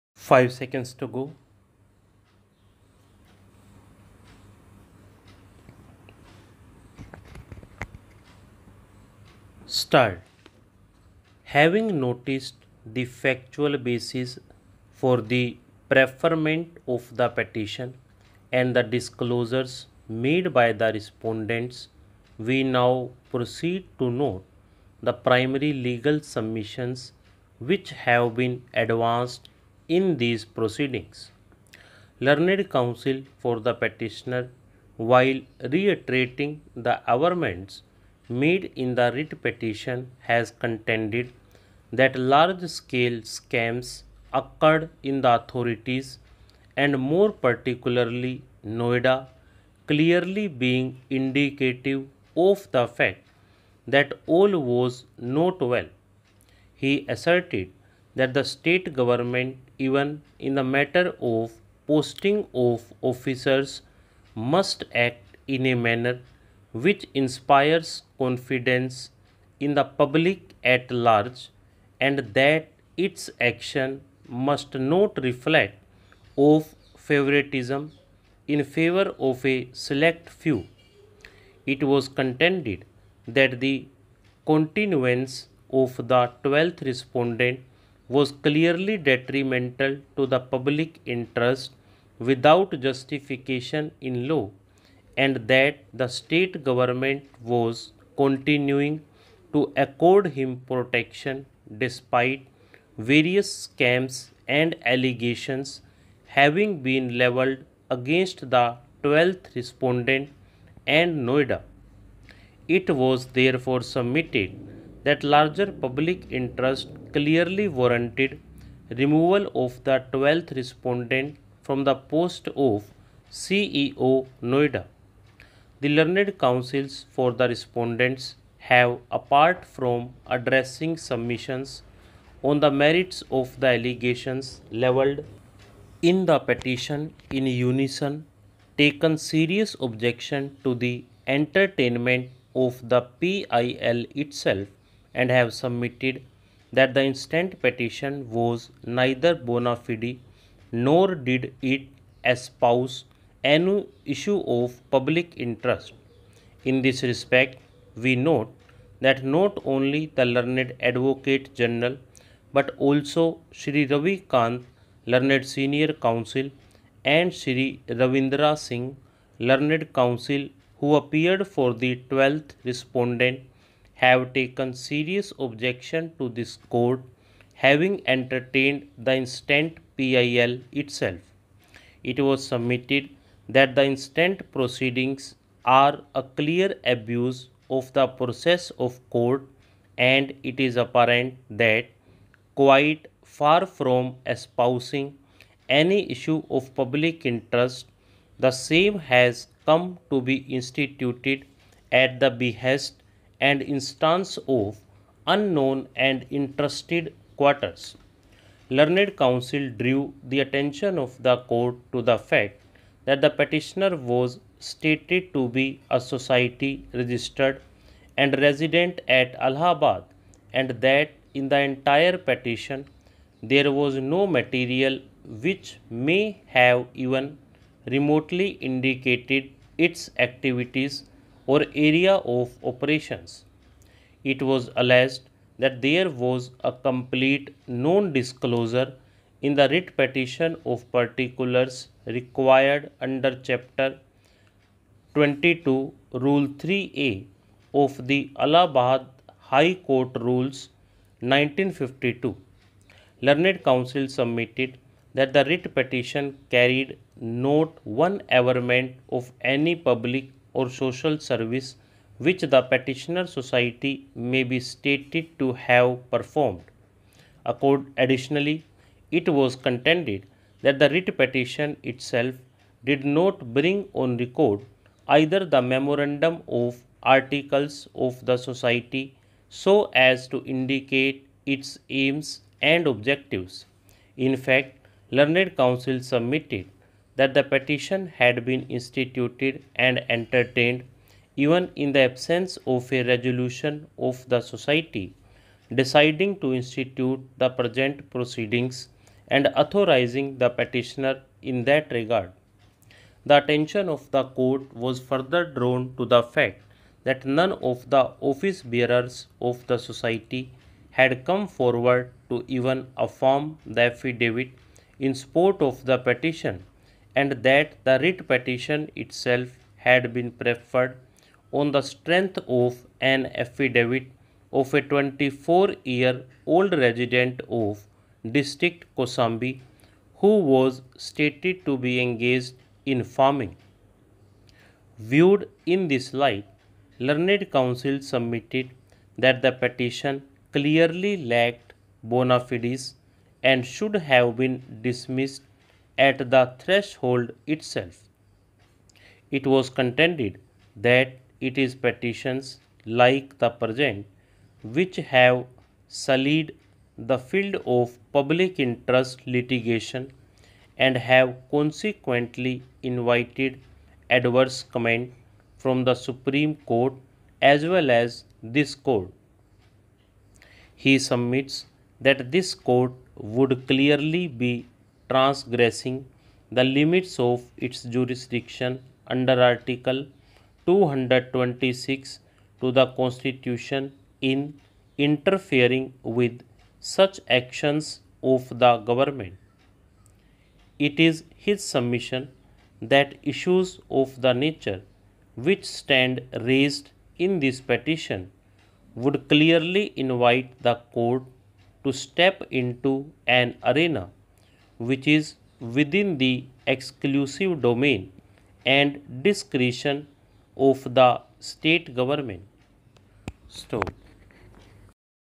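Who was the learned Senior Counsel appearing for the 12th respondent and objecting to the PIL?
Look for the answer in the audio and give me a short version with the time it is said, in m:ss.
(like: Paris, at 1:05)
Ravi Kant, at 2:43.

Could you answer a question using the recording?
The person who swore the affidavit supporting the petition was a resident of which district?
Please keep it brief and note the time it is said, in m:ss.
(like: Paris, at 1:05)
Kaushambi, at 5:28.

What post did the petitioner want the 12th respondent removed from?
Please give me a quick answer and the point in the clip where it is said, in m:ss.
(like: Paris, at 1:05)
CEO Noida, at 2:03.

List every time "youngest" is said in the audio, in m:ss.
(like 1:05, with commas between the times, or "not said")
not said.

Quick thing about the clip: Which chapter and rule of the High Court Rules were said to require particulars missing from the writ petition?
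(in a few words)
Chapter 22, Rule 3A.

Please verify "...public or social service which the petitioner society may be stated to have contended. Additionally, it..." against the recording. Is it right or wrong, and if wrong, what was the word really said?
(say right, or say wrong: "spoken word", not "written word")
wrong: "performed", not "contended".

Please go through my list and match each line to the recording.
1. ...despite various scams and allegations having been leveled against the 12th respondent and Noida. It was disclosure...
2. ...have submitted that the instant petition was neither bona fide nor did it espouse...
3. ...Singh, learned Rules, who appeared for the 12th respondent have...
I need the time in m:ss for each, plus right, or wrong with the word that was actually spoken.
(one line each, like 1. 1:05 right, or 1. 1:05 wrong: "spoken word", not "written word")
1. 1:41 wrong: "therefore", not "disclosure"
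2. 2:25 right
3. 2:48 wrong: "Counsel", not "Rules".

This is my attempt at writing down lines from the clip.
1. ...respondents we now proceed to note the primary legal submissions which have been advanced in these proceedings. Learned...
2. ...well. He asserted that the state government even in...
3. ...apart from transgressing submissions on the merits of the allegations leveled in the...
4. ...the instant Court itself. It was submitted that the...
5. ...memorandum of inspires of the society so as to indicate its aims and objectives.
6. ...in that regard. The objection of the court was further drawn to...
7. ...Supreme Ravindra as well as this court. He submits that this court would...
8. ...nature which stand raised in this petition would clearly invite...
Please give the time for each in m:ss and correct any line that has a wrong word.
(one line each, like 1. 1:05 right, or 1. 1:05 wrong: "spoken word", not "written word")
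1. 0:21 right
2. 0:55 right
3. 2:09 wrong: "addressing", not "transgressing"
4. 2:58 wrong: "PIL", not "Court"
5. 4:35 wrong: "articles", not "inspires"
6. 5:01 wrong: "attention", not "objection"
7. 6:06 wrong: "Court", not "Ravindra"
8. 6:34 right.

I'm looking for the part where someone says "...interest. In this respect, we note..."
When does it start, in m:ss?
2:35.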